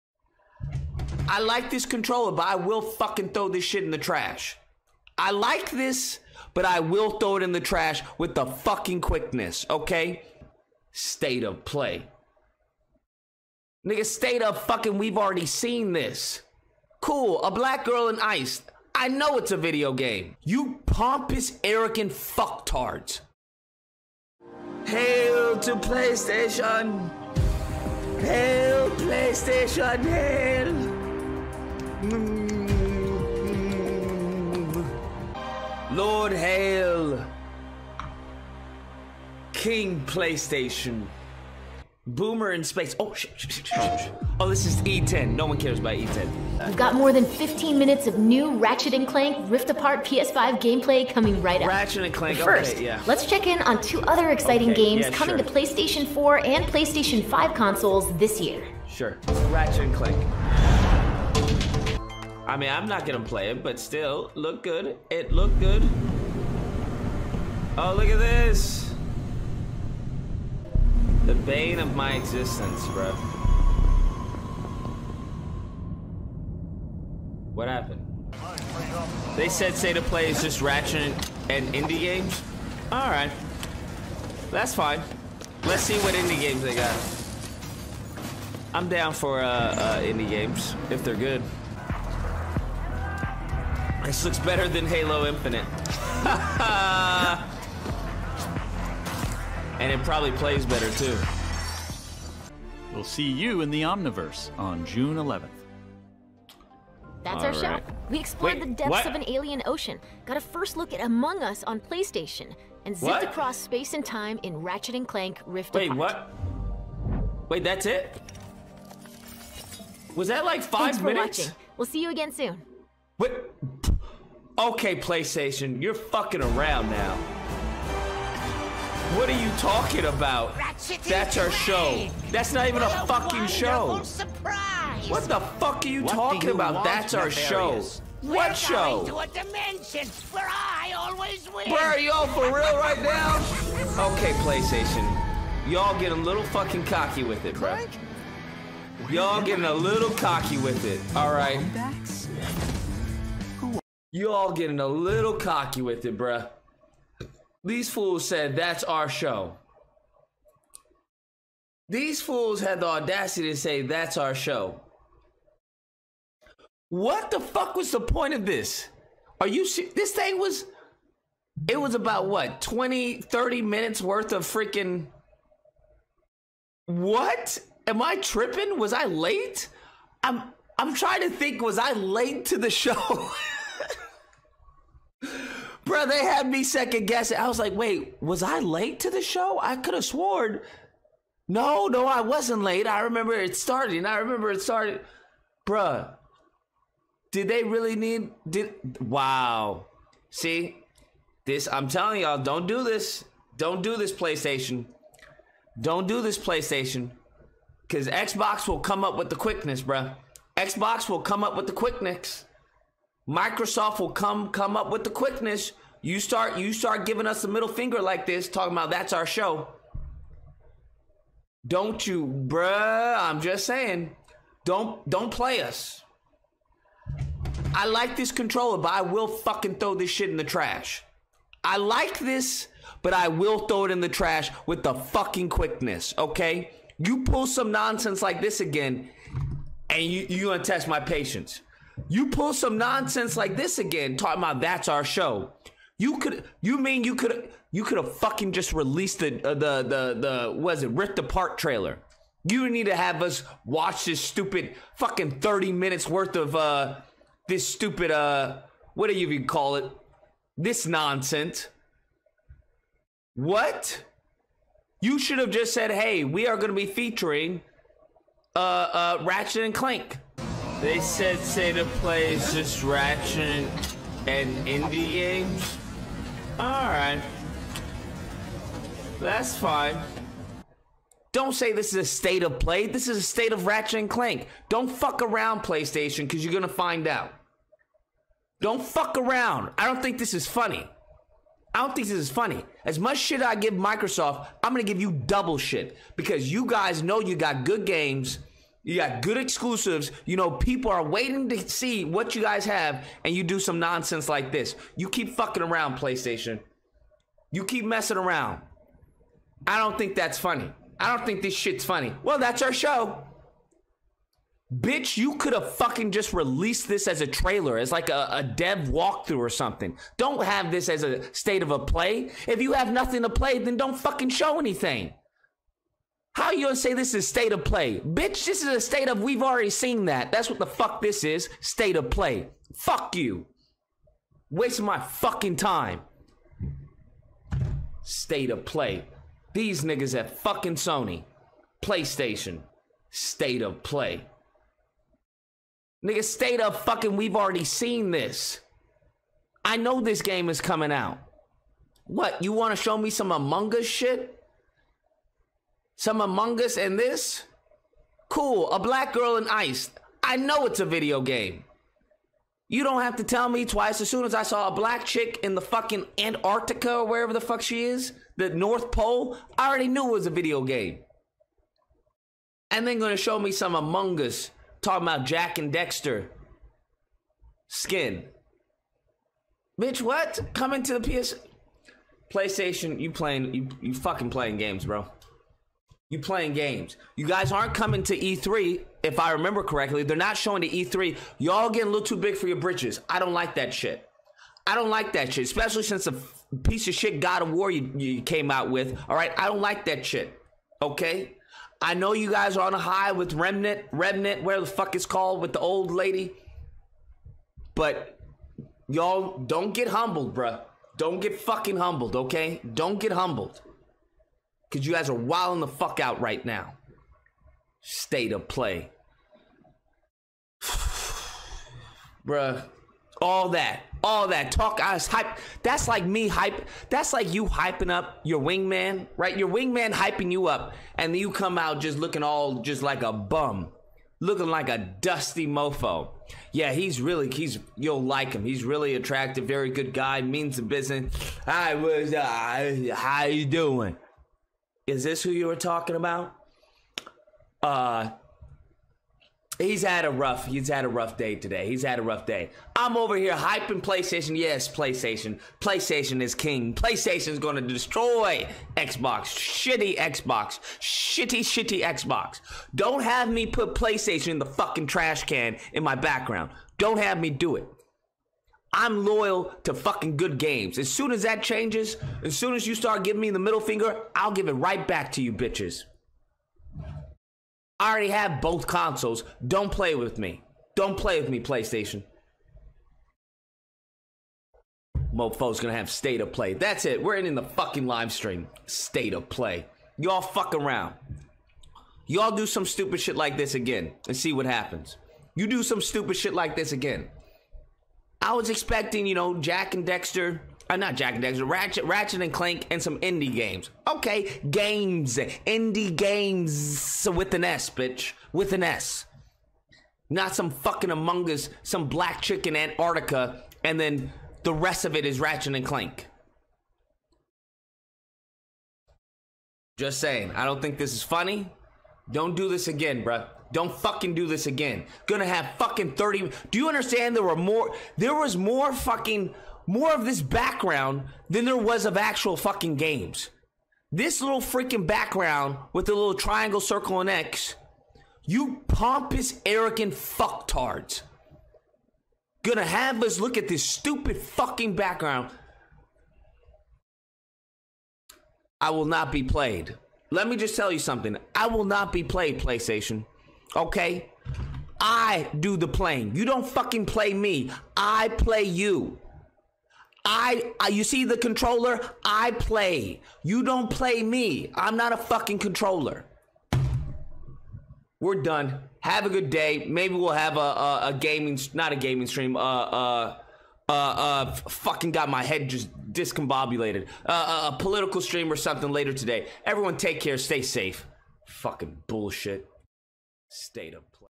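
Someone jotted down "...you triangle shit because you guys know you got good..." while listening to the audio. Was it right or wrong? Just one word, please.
wrong.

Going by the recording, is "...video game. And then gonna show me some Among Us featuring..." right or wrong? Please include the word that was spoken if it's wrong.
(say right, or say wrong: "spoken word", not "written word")
wrong: "talking", not "featuring".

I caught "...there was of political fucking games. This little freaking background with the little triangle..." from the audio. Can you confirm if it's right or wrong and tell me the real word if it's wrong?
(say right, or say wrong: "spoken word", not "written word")
wrong: "actual", not "political".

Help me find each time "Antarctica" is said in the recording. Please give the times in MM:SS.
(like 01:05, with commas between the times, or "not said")
06:06, 08:32.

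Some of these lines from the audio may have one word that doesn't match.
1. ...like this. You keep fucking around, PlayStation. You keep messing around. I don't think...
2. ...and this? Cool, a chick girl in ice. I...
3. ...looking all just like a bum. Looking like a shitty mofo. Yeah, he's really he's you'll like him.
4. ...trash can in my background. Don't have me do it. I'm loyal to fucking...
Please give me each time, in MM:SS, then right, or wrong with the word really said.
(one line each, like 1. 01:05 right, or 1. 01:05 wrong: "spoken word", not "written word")
1. 05:04 right
2. 05:56 wrong: "black", not "chick"
3. 07:11 wrong: "dusty", not "shitty"
4. 07:44 right.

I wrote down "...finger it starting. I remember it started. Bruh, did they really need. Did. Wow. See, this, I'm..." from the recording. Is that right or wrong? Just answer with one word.
wrong.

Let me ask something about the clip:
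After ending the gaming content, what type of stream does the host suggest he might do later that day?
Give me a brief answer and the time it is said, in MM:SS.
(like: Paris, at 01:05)
Political stream, at 09:37.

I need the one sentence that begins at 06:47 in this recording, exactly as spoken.
But y'all don't get humbled, bruh.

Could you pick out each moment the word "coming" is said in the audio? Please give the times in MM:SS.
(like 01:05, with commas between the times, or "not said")
00:51, 00:55, 05:50, 06:20, 06:27.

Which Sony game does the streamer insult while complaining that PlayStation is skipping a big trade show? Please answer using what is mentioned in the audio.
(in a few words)
God of War.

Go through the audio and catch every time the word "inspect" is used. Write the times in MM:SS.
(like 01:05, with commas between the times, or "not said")
not said.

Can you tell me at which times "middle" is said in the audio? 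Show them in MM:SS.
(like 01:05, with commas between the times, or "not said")
03:37, 07:53.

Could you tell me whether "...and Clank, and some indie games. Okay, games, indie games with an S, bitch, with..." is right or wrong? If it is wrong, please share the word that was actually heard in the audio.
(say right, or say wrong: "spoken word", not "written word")
right.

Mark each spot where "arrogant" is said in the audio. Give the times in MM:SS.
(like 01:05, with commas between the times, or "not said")
00:21, 08:59.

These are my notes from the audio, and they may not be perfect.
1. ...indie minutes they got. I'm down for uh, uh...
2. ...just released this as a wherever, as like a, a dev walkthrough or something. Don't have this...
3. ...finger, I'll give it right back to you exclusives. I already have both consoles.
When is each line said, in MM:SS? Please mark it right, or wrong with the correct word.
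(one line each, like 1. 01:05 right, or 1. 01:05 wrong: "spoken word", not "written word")
1. 01:26 wrong: "games", not "minutes"
2. 05:16 wrong: "trailer", not "wherever"
3. 07:53 wrong: "bitches", not "exclusives".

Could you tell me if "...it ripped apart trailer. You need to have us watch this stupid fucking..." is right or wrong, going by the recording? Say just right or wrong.
right.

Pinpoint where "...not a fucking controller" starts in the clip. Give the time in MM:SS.
09:24.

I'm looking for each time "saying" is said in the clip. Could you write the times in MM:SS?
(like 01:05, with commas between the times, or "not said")
03:43, 08:39.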